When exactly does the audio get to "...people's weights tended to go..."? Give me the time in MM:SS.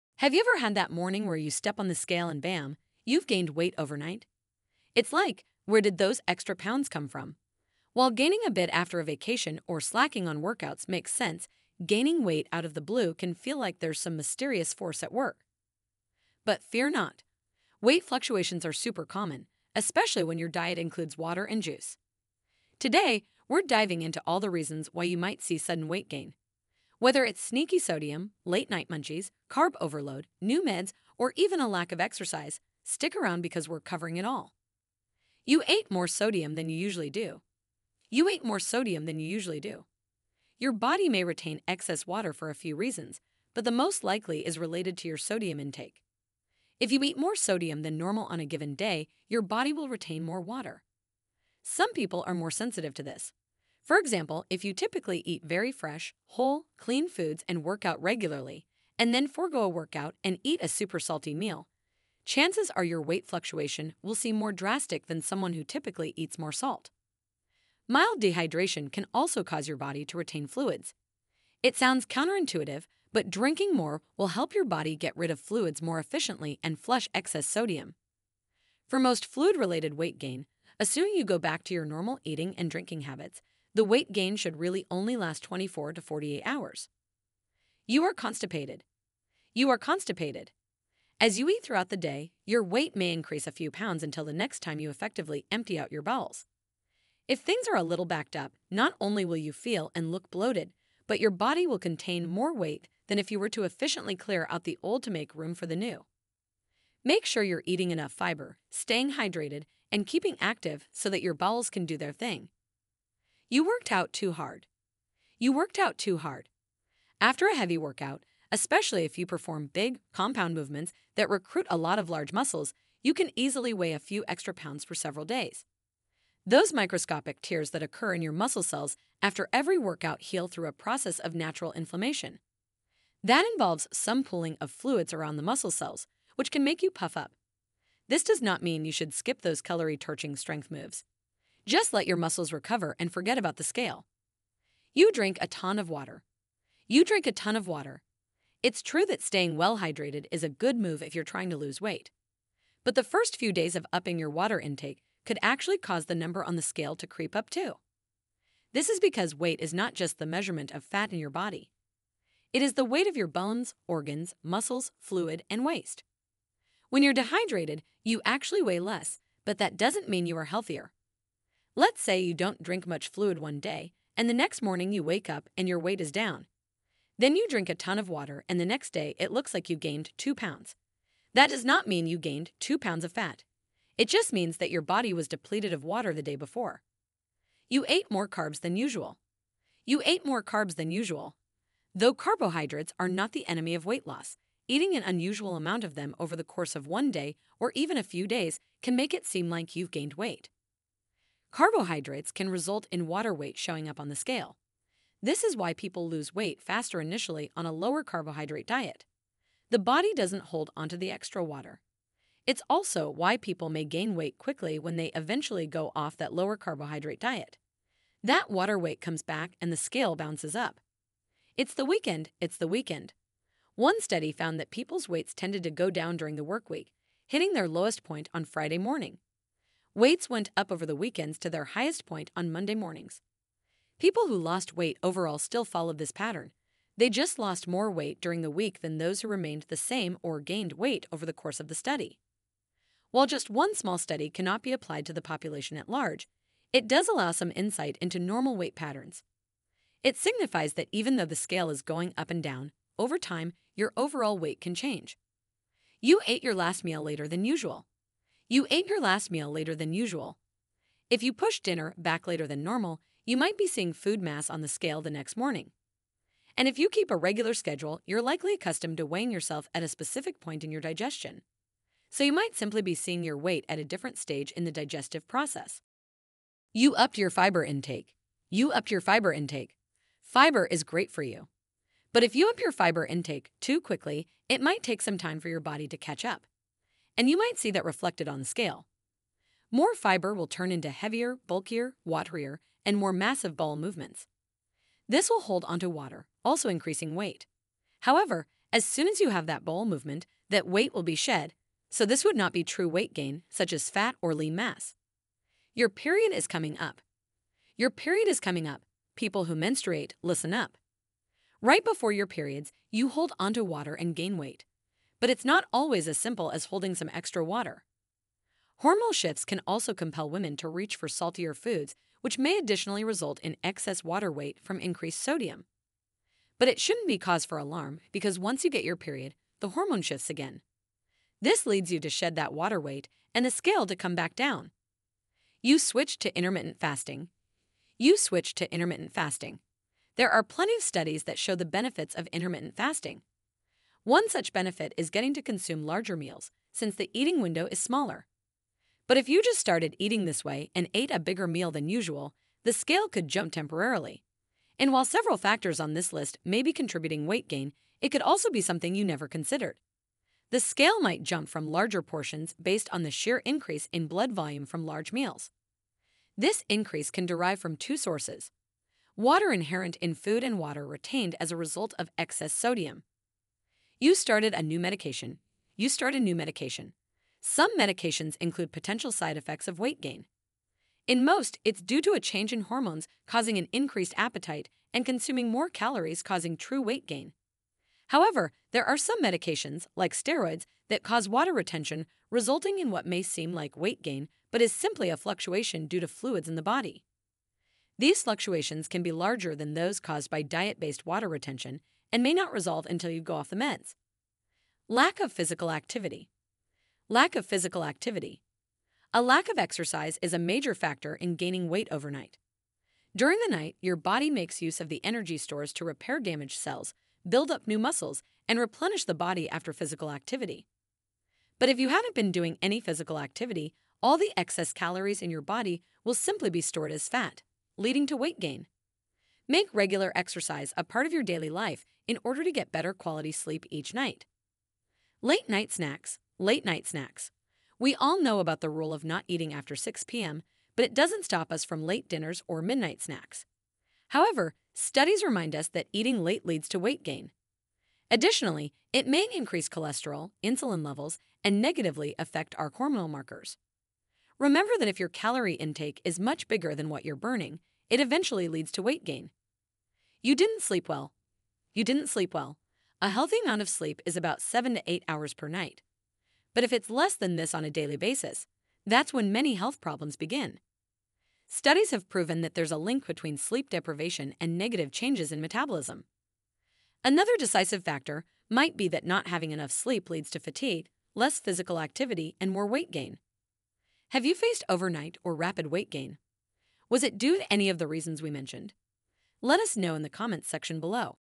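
03:44.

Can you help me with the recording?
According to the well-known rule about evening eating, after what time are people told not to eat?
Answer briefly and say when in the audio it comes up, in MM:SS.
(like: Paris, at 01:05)
6 p.m., at 07:19.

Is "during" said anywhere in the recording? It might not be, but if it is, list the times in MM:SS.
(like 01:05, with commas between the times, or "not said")
03:46, 03:58, 06:53.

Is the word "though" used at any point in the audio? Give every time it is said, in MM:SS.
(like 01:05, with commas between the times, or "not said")
03:11, 04:11.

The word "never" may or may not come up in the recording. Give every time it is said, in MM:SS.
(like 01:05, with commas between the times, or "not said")
05:59.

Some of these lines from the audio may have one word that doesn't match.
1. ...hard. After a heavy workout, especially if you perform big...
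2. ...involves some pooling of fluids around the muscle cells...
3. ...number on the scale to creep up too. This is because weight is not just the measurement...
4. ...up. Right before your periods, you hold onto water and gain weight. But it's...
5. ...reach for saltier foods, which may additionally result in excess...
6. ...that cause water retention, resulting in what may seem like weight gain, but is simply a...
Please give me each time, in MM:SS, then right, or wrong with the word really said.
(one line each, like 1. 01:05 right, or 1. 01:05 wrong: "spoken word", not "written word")
1. 01:56 right
2. 02:13 right
3. 02:36 right
4. 05:10 right
5. 05:20 right
6. 06:30 right.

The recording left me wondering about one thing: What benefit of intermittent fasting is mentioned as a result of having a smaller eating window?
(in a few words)
Larger meals.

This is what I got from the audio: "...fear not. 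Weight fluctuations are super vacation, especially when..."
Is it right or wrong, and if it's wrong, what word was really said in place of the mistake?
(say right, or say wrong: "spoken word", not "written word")
wrong: "common", not "vacation".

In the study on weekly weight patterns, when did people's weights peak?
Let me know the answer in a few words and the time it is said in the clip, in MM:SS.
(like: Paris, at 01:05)
Monday mornings, at 03:52.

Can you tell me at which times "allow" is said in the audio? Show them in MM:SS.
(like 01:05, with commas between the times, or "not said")
04:07.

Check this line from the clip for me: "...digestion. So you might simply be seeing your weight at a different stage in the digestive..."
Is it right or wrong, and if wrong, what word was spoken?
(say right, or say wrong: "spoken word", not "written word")
right.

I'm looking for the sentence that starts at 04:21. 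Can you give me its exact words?
If you push dinner back later than normal, you might be seeing food mass on the scale the next morning.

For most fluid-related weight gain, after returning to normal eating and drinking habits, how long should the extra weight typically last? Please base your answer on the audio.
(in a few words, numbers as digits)
24 to 48 hours.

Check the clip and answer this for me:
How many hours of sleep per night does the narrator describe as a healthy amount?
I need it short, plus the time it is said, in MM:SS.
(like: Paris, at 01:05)
7 to 8 hours, at 07:44.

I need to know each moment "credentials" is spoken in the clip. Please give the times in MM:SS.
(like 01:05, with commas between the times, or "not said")
not said.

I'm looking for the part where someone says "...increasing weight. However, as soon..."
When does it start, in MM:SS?
04:56.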